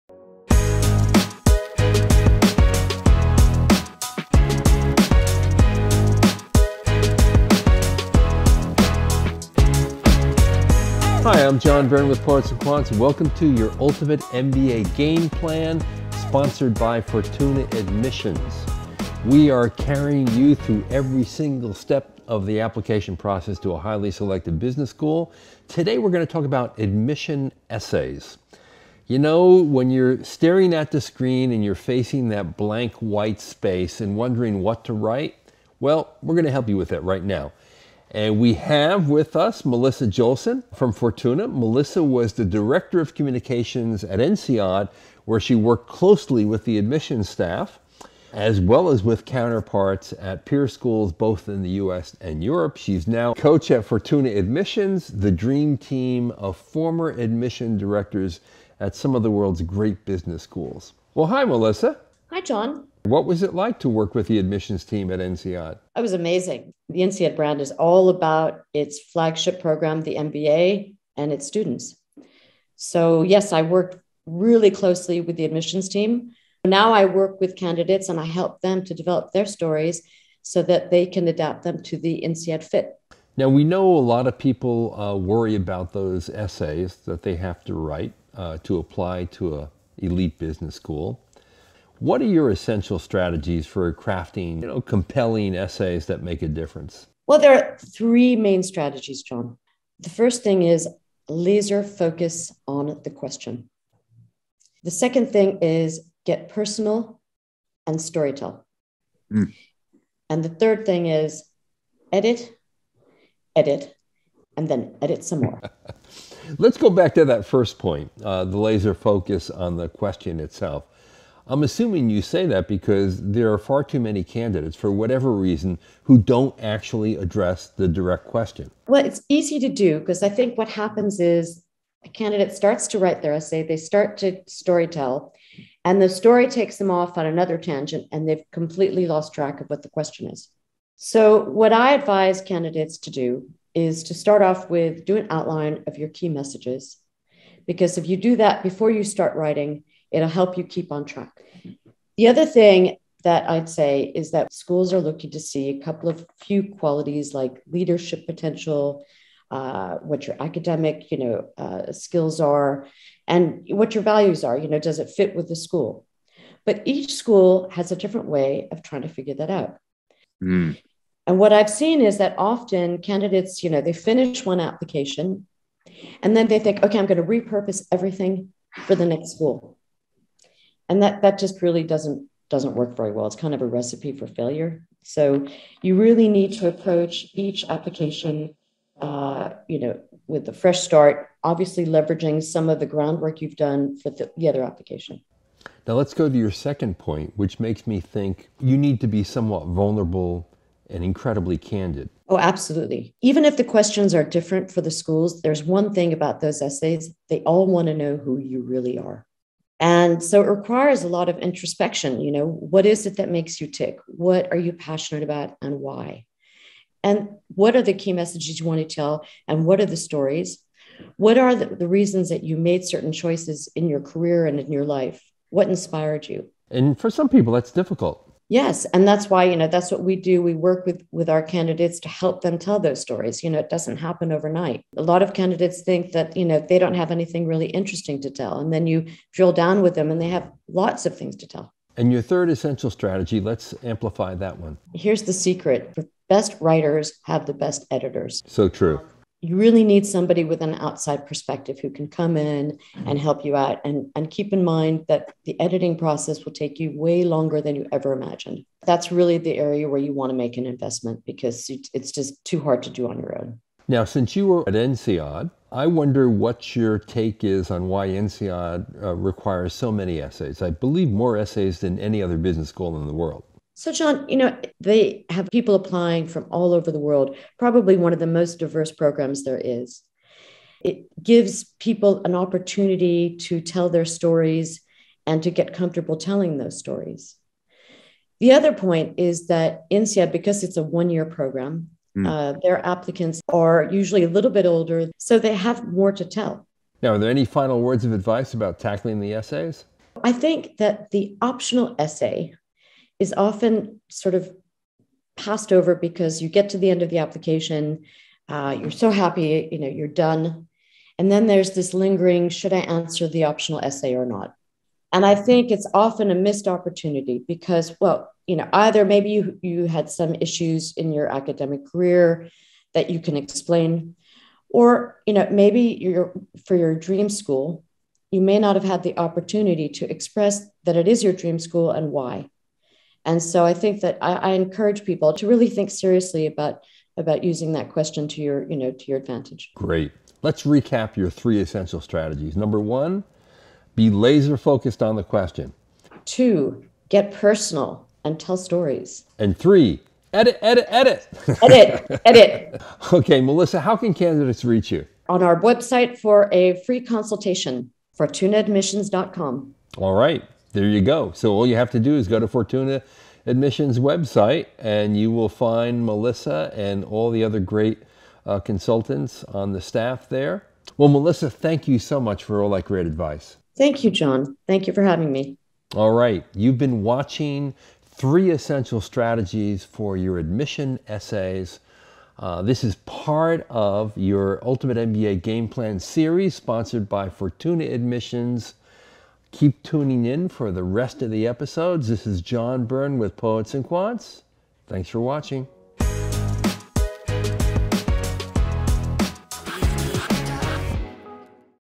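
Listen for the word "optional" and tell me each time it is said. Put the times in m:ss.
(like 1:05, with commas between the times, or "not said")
5:01, 5:13.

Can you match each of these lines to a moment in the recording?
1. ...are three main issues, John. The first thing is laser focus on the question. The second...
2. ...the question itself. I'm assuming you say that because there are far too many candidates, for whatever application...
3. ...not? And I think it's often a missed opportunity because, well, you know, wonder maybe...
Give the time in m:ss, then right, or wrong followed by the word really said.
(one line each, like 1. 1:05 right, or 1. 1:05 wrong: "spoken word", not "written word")
1. 1:37 wrong: "strategies", not "issues"
2. 1:59 wrong: "reason", not "application"
3. 5:14 wrong: "either", not "wonder".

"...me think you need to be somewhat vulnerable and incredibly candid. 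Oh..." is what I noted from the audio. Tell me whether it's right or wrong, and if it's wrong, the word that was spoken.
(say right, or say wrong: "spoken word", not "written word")
right.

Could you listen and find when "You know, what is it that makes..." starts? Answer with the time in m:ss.
3:32.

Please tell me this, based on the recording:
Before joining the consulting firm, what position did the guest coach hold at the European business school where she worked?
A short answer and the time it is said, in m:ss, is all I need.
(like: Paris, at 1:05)
Director of Communications, at 0:42.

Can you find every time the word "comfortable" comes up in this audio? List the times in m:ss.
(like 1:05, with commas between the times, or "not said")
4:45.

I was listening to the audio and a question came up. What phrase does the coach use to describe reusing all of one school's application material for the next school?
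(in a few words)
recipe for failure.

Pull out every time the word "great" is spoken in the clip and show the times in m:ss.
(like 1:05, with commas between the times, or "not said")
0:59, 5:39, 6:07, 6:12.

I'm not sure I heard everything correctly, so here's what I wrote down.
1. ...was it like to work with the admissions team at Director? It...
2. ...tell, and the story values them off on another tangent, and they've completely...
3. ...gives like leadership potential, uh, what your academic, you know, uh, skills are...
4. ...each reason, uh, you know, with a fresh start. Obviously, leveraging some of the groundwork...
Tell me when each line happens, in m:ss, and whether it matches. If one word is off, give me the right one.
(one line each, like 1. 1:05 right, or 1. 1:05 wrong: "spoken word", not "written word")
1. 1:03 wrong: "INSEAD", not "Director"
2. 2:14 wrong: "takes", not "values"
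3. 2:36 wrong: "qualities", not "gives"
4. 3:07 wrong: "application", not "reason".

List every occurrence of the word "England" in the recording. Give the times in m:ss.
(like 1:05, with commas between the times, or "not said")
not said.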